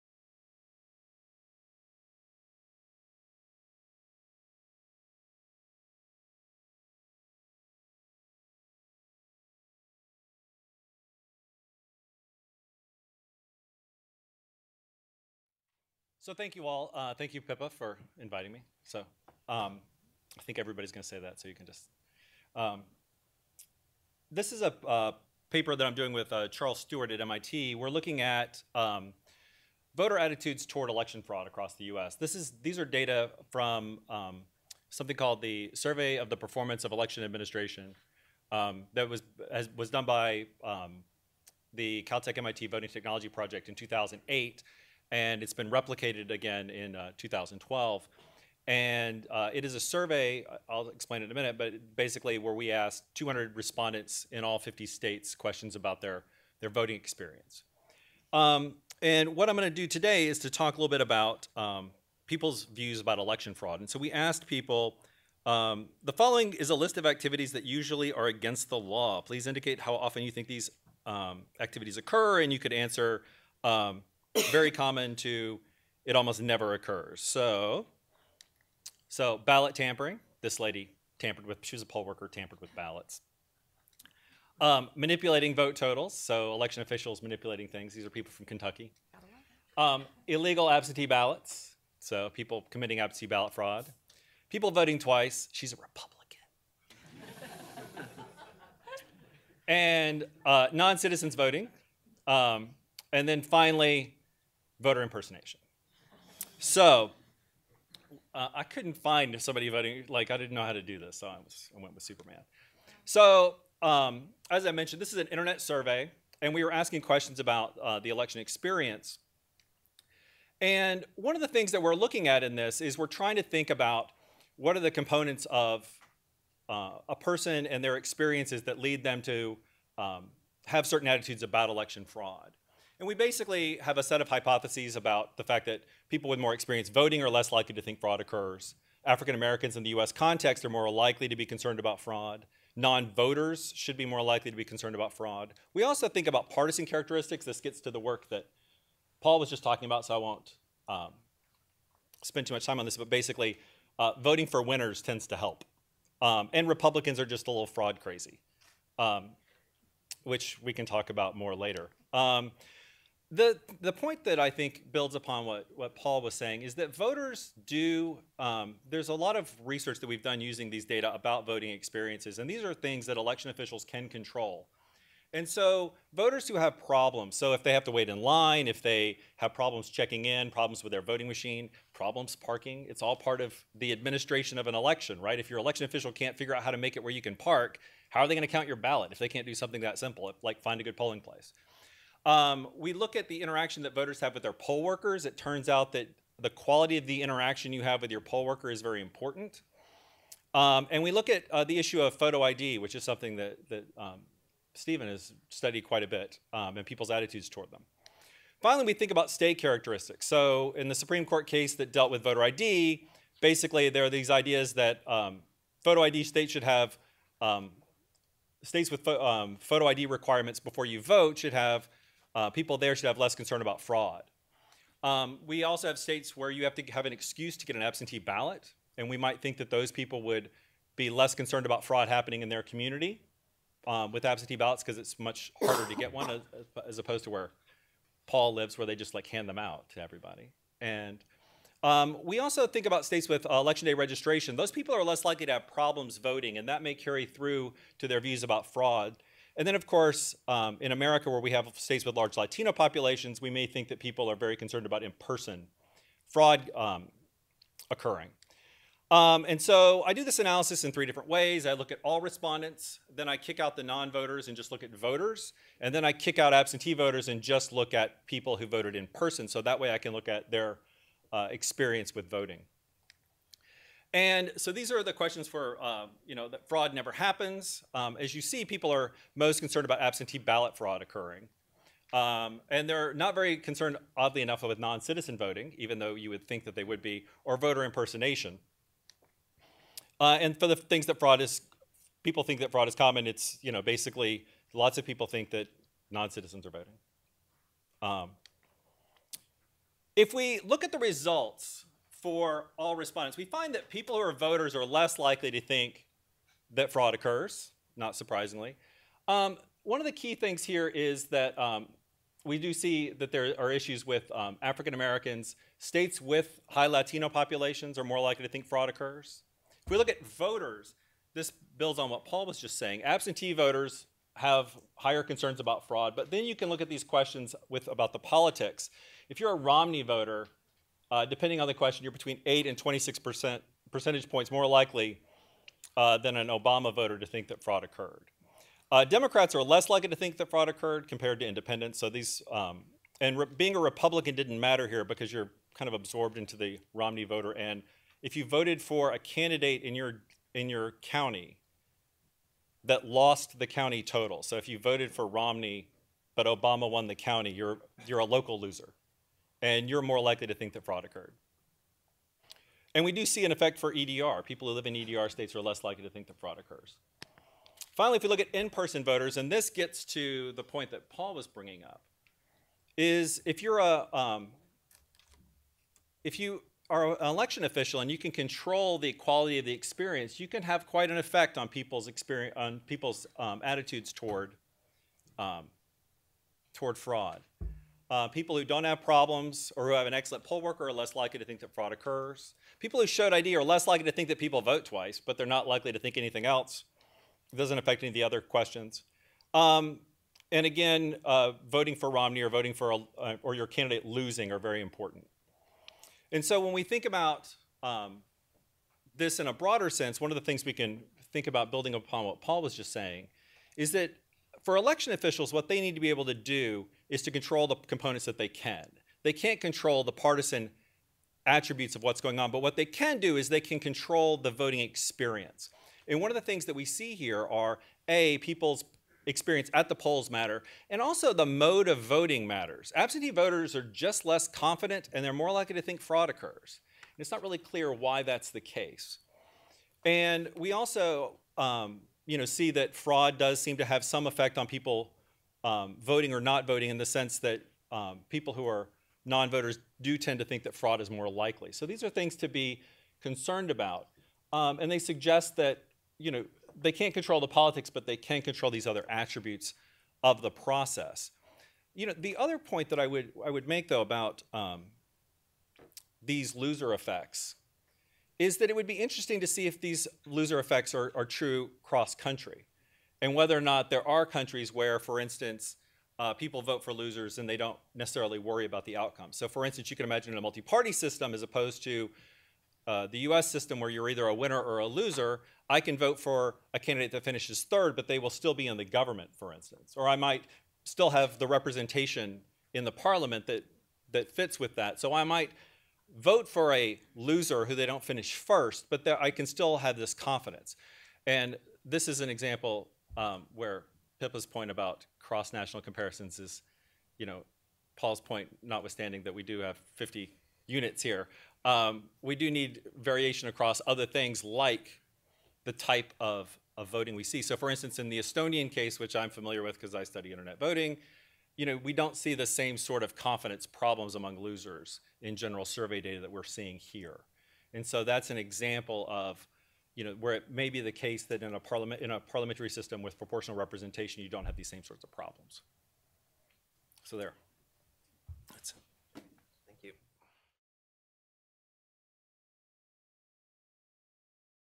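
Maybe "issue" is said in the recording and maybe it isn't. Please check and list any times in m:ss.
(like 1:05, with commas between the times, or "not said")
3:21, 5:13.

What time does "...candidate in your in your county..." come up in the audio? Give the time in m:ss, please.
5:49.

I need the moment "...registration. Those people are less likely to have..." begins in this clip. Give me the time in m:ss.
4:03.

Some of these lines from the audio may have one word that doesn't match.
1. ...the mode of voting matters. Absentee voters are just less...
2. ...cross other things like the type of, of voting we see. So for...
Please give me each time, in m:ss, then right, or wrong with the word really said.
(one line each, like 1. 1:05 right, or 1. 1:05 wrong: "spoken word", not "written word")
1. 7:11 right
2. 8:33 wrong: "across", not "cross".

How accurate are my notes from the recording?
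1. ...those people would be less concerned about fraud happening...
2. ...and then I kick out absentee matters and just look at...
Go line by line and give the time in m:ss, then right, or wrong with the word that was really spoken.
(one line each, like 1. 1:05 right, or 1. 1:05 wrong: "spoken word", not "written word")
1. 3:49 right
2. 4:25 wrong: "voters", not "matters".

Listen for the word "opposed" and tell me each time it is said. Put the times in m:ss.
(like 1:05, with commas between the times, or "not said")
3:56, 8:01.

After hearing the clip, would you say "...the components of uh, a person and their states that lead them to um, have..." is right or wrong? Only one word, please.
wrong.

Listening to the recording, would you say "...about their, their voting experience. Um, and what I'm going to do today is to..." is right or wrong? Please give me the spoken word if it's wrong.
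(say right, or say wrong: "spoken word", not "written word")
right.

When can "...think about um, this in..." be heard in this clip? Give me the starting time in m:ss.
6:46.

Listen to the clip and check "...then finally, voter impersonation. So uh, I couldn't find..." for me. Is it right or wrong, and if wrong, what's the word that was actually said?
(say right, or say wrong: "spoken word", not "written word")
right.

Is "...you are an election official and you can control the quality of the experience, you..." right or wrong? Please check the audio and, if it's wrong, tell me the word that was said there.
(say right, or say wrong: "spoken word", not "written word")
right.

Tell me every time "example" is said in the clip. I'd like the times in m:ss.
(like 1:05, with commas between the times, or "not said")
8:22, 8:48.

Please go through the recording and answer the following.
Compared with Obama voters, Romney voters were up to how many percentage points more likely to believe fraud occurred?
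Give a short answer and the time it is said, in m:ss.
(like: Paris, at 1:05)
26, at 5:32.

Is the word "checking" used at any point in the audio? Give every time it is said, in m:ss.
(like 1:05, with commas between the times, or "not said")
2:59.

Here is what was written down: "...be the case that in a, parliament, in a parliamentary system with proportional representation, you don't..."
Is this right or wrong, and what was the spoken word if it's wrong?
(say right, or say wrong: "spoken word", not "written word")
right.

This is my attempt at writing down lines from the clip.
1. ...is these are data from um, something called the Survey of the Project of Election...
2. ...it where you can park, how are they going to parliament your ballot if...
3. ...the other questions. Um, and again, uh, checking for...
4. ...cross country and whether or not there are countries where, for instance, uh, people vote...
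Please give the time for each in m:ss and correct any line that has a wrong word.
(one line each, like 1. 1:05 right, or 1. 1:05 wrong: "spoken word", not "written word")
1. 0:32 wrong: "Performance", not "Project"
2. 3:06 wrong: "count", not "parliament"
3. 6:38 wrong: "voting", not "checking"
4. 7:51 right.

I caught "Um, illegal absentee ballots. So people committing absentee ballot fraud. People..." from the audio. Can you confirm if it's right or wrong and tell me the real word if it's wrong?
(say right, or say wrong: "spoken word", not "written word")
right.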